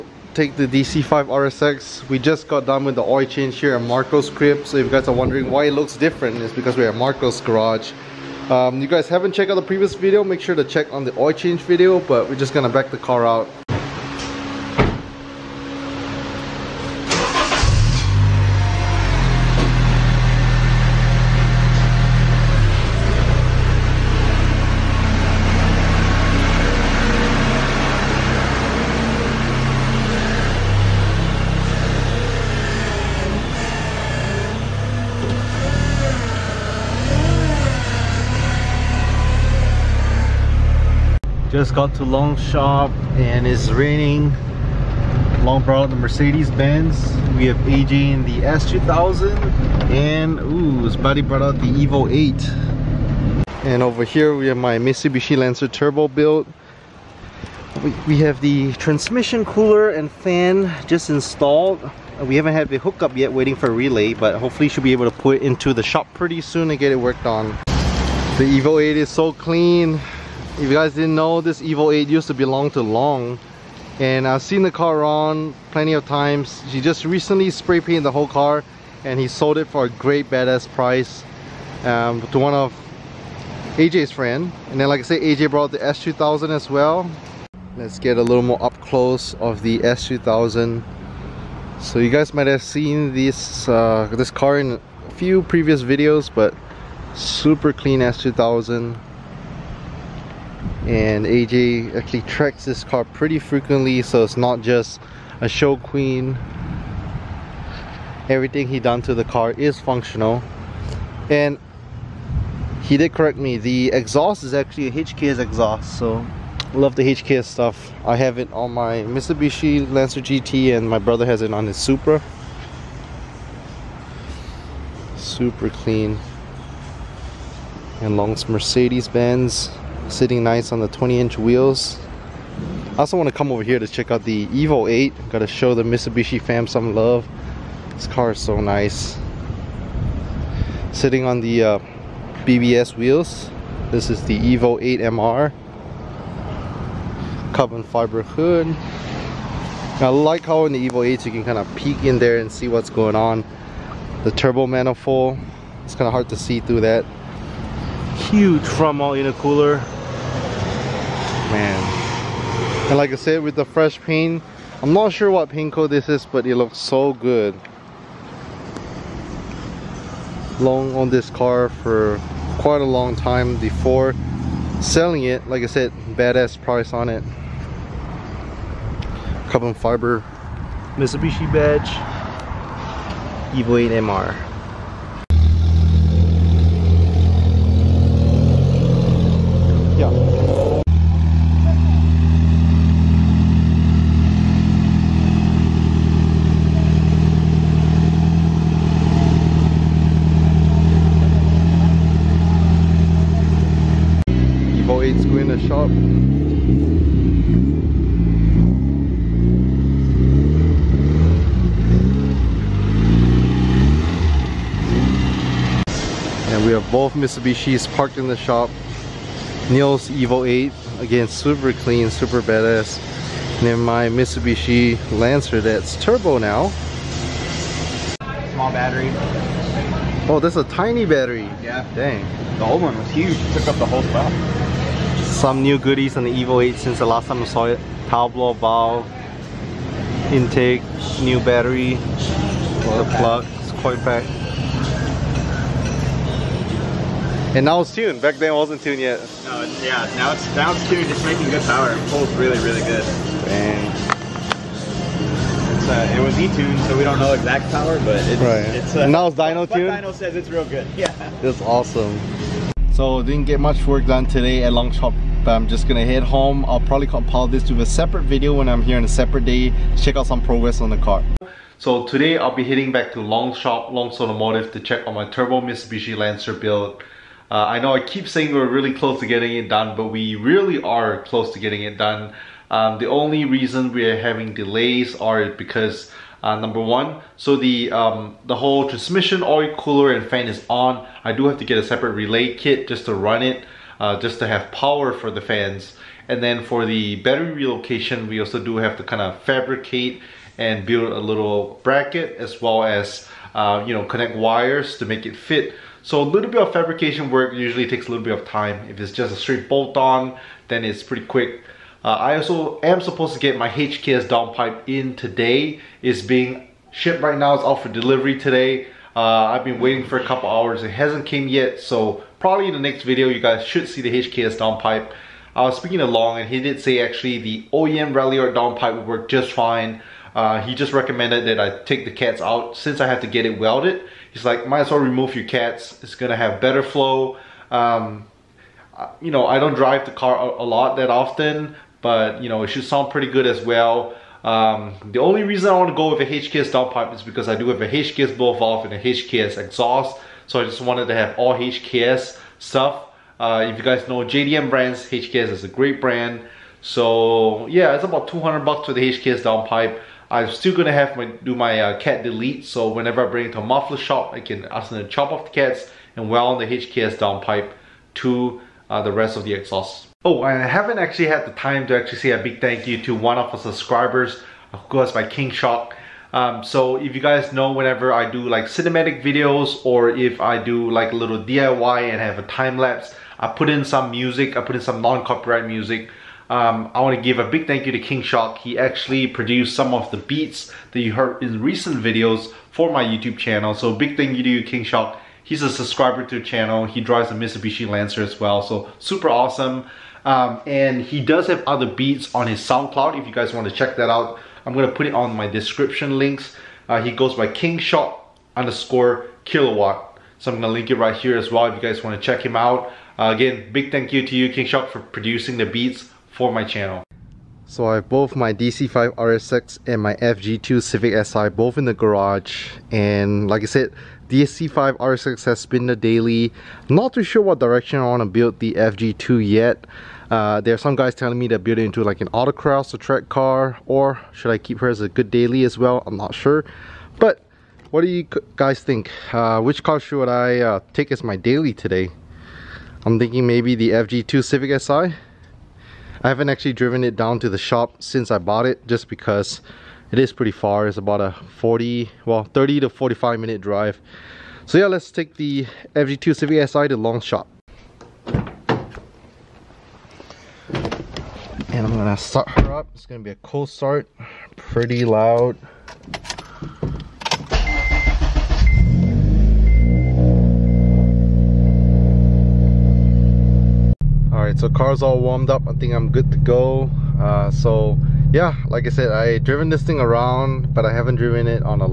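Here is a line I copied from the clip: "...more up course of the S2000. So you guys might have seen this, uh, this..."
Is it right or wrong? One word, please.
wrong.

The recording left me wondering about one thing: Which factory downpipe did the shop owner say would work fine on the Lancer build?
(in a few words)
OEM Ralliart.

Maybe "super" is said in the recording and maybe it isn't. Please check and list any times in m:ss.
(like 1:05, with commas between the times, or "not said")
1:37, 2:05, 6:38.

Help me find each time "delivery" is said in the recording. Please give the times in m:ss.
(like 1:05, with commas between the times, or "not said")
5:17.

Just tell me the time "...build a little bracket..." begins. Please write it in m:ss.
5:00.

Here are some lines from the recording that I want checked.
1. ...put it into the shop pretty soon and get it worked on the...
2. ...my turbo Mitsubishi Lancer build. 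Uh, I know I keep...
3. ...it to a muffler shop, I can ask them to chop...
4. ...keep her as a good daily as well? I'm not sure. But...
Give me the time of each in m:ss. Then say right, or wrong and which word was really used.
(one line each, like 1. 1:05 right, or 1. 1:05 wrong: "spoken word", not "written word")
1. 1:05 right
2. 4:35 right
3. 6:03 right
4. 7:14 right.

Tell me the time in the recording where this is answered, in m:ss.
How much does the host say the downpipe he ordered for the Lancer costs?
5:58.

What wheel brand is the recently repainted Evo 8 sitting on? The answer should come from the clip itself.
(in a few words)
BBS.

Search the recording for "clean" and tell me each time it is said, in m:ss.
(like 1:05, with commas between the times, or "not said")
1:09, 1:37, 2:05.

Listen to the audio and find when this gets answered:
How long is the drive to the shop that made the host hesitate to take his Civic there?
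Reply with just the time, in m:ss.
7:32.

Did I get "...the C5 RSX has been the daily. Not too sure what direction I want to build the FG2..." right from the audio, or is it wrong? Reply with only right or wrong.
right.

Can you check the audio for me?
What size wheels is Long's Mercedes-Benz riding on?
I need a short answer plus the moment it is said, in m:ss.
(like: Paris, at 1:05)
20 inch, at 2:10.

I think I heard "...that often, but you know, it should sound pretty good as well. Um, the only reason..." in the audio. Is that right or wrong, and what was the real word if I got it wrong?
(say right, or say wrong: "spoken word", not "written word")
right.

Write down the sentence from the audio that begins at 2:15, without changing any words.
Got to show the Mitsubishi fam some love.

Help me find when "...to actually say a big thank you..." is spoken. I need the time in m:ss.
6:11.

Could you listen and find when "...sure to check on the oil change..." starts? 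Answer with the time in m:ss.
0:10.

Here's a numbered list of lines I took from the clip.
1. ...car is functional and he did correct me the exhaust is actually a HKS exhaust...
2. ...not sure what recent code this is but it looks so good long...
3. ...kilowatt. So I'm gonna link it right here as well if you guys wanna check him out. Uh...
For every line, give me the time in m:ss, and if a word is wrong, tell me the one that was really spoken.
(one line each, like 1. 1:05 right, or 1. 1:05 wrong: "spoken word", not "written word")
1. 1:49 right
2. 2:44 wrong: "paint", not "recent"
3. 6:49 right.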